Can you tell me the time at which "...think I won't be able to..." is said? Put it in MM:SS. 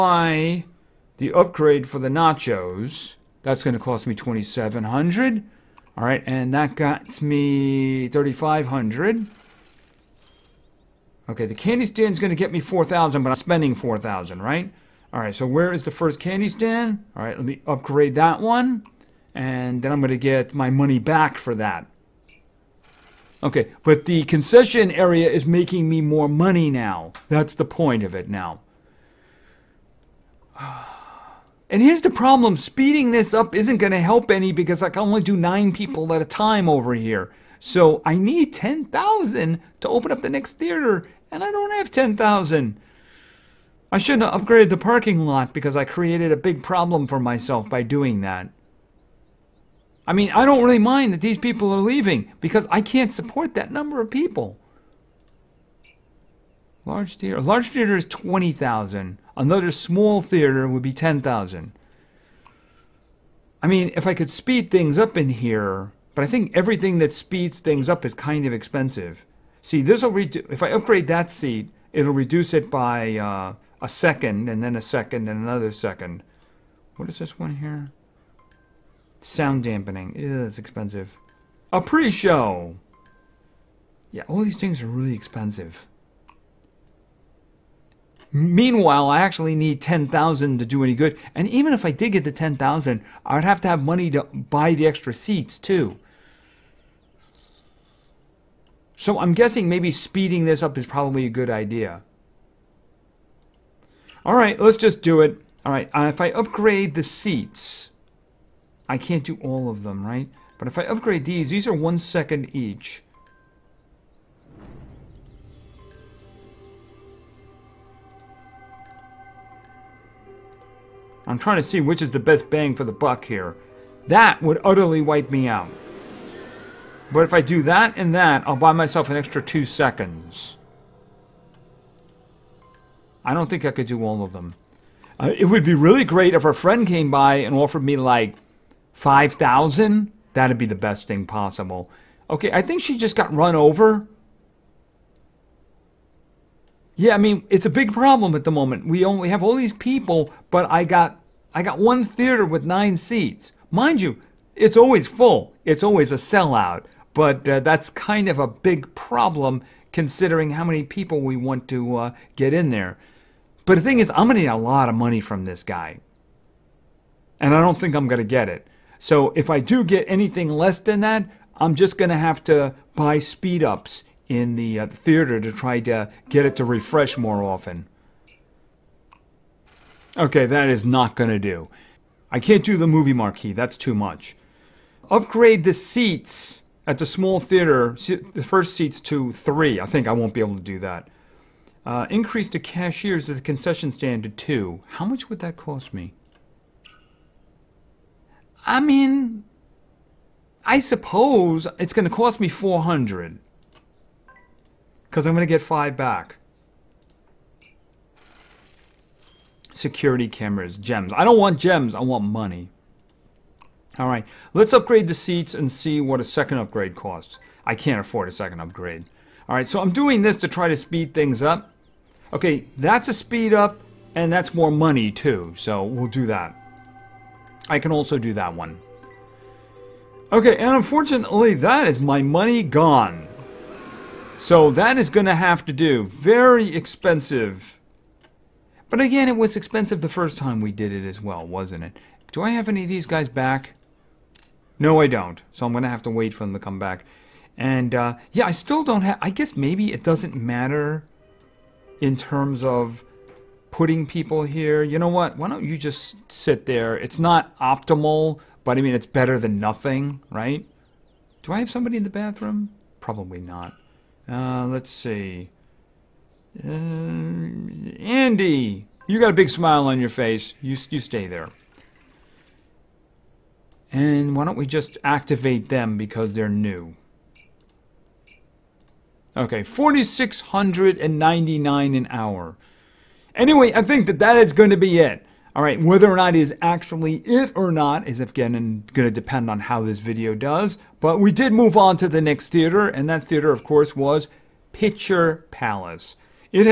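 03:09.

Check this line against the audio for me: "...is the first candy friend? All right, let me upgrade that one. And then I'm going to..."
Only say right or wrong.
wrong.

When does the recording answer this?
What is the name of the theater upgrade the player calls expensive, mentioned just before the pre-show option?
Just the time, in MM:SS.
01:19.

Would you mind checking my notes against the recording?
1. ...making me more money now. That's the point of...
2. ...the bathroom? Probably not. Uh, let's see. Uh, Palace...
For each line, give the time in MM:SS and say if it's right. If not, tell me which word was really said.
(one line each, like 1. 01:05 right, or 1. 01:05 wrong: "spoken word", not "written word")
1. 00:25 right
2. 04:22 wrong: "Andy", not "Palace".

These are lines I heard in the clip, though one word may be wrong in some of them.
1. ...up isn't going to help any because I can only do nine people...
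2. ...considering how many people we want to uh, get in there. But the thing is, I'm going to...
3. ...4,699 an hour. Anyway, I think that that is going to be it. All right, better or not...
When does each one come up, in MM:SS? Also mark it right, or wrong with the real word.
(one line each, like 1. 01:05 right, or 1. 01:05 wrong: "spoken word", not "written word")
1. 00:33 right
2. 02:39 right
3. 04:39 wrong: "whether", not "better".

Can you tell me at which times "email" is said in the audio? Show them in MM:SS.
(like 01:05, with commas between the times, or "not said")
not said.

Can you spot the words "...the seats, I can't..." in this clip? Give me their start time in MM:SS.
01:46.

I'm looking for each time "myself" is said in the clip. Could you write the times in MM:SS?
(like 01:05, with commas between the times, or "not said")
00:47, 02:08.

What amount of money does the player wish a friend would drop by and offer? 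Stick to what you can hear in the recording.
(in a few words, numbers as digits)
5,000.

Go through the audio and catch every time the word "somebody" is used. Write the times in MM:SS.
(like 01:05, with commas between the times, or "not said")
04:21.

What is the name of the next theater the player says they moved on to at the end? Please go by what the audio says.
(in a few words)
Picture Palace.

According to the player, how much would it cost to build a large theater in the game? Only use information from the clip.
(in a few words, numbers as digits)
20,000.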